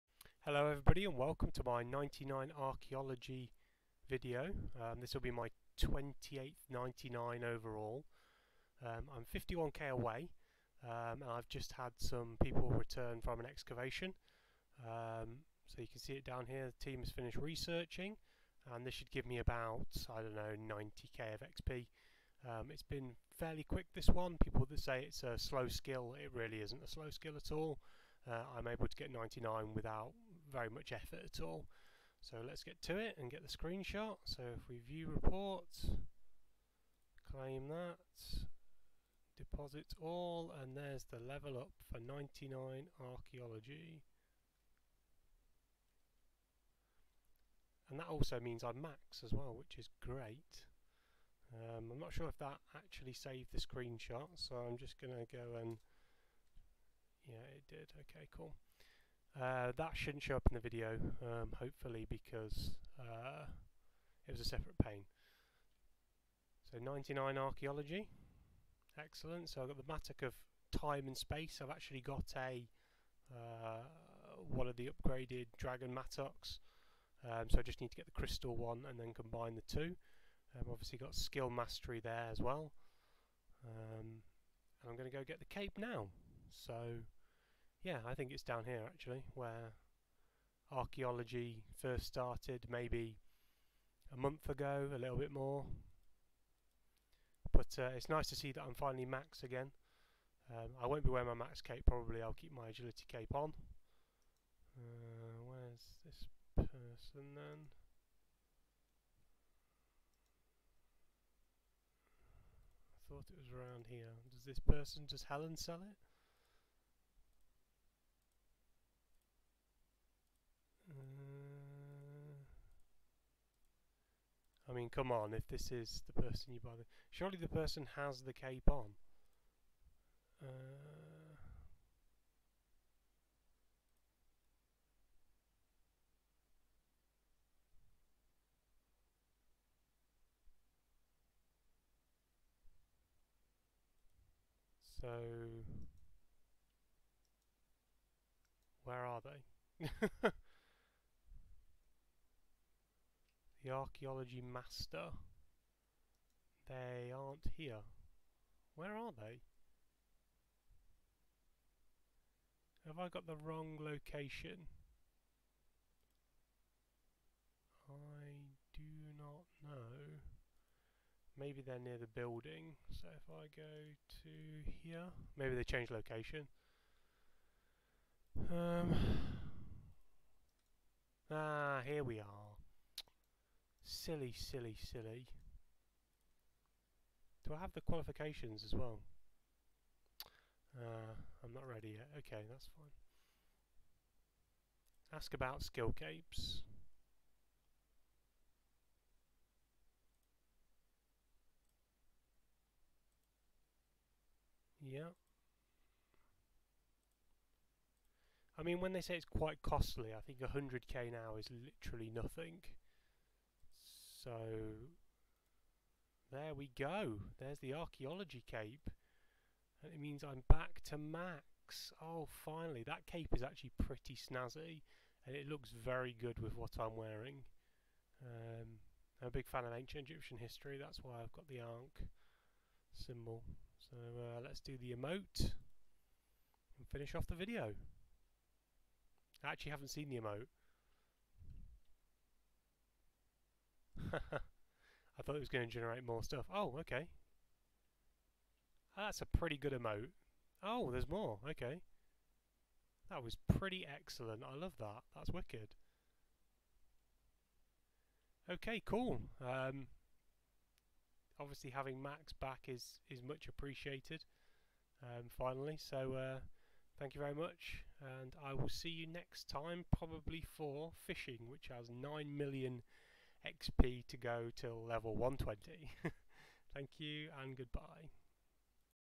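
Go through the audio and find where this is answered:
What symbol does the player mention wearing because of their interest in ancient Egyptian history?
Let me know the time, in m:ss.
3:51.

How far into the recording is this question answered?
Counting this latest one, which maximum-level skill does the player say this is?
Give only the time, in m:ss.
0:05.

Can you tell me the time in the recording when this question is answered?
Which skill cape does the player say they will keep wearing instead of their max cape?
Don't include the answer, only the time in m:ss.
1:42.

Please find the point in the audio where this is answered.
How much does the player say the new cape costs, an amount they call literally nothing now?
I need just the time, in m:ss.
3:30.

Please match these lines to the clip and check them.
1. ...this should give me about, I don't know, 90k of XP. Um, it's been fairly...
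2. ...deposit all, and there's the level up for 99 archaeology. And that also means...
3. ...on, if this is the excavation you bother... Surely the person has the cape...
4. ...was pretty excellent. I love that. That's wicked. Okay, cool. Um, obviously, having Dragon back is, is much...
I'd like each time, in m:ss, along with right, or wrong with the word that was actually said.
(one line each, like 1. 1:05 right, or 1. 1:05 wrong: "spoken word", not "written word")
1. 0:18 right
2. 0:39 right
3. 2:05 wrong: "person", not "excavation"
4. 4:13 wrong: "Max", not "Dragon".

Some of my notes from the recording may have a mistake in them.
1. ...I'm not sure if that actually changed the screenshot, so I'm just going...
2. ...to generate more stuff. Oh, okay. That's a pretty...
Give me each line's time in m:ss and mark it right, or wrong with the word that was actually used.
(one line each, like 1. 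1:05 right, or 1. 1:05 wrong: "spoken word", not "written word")
1. 0:51 wrong: "saved", not "changed"
2. 4:05 right.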